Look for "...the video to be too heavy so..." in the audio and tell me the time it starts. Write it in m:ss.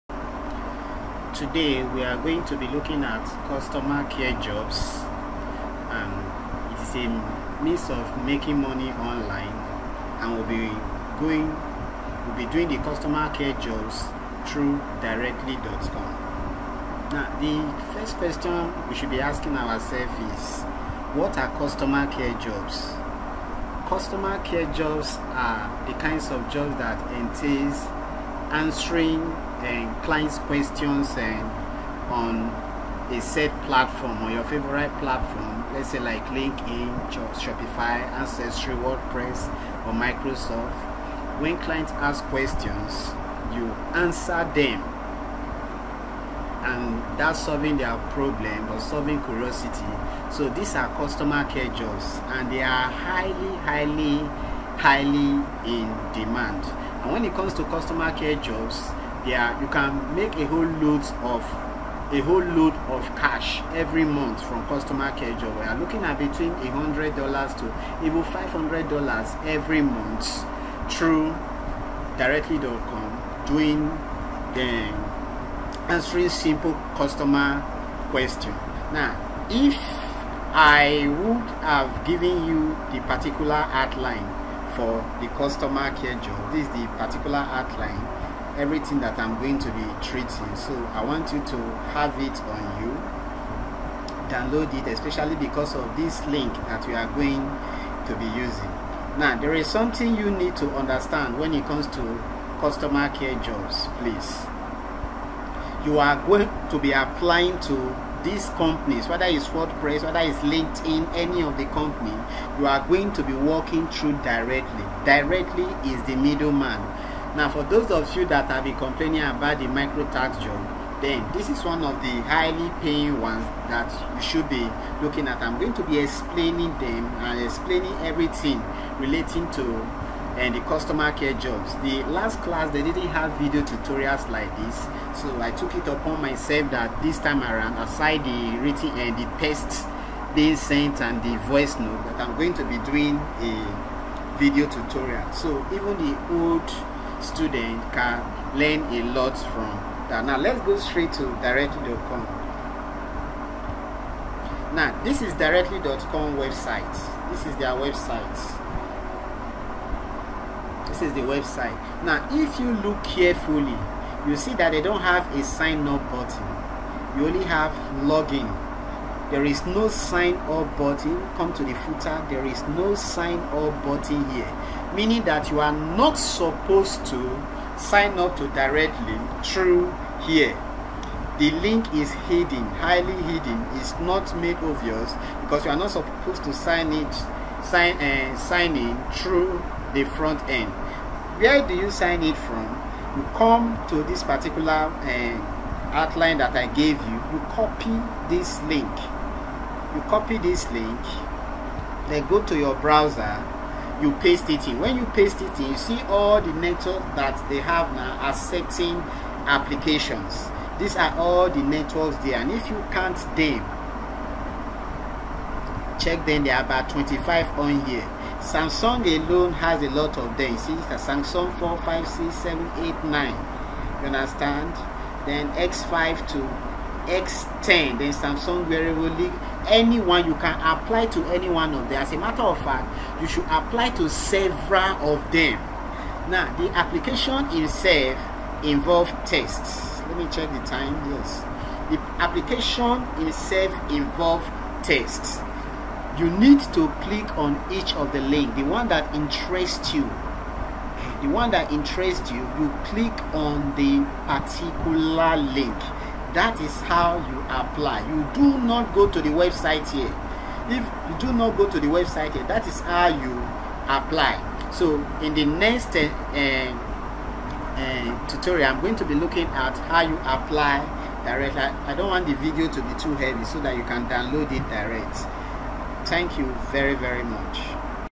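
4:32.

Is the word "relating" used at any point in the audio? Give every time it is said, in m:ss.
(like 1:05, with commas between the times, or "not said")
2:08.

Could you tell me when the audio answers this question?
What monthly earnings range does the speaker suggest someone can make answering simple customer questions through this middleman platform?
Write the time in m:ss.
1:06.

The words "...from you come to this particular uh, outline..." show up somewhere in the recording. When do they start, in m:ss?
3:12.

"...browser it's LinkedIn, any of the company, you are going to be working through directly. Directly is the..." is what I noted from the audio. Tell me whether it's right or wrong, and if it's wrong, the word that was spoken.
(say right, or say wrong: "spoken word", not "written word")
wrong: "whether", not "browser".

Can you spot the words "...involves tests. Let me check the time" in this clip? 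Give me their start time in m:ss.
3:58.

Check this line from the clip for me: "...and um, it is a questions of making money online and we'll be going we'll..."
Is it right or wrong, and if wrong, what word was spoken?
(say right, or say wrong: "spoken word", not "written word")
wrong: "means", not "questions".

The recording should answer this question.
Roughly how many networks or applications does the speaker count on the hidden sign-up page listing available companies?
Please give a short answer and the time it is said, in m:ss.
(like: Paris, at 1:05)
25, at 3:36.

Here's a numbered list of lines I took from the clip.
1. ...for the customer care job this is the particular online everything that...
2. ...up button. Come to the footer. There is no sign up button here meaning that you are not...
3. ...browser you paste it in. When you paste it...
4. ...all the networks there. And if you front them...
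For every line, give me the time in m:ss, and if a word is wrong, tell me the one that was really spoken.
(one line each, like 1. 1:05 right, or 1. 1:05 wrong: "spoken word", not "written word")
1. 1:24 wrong: "outline", not "online"
2. 2:50 right
3. 3:22 right
4. 3:31 wrong: "count", not "front".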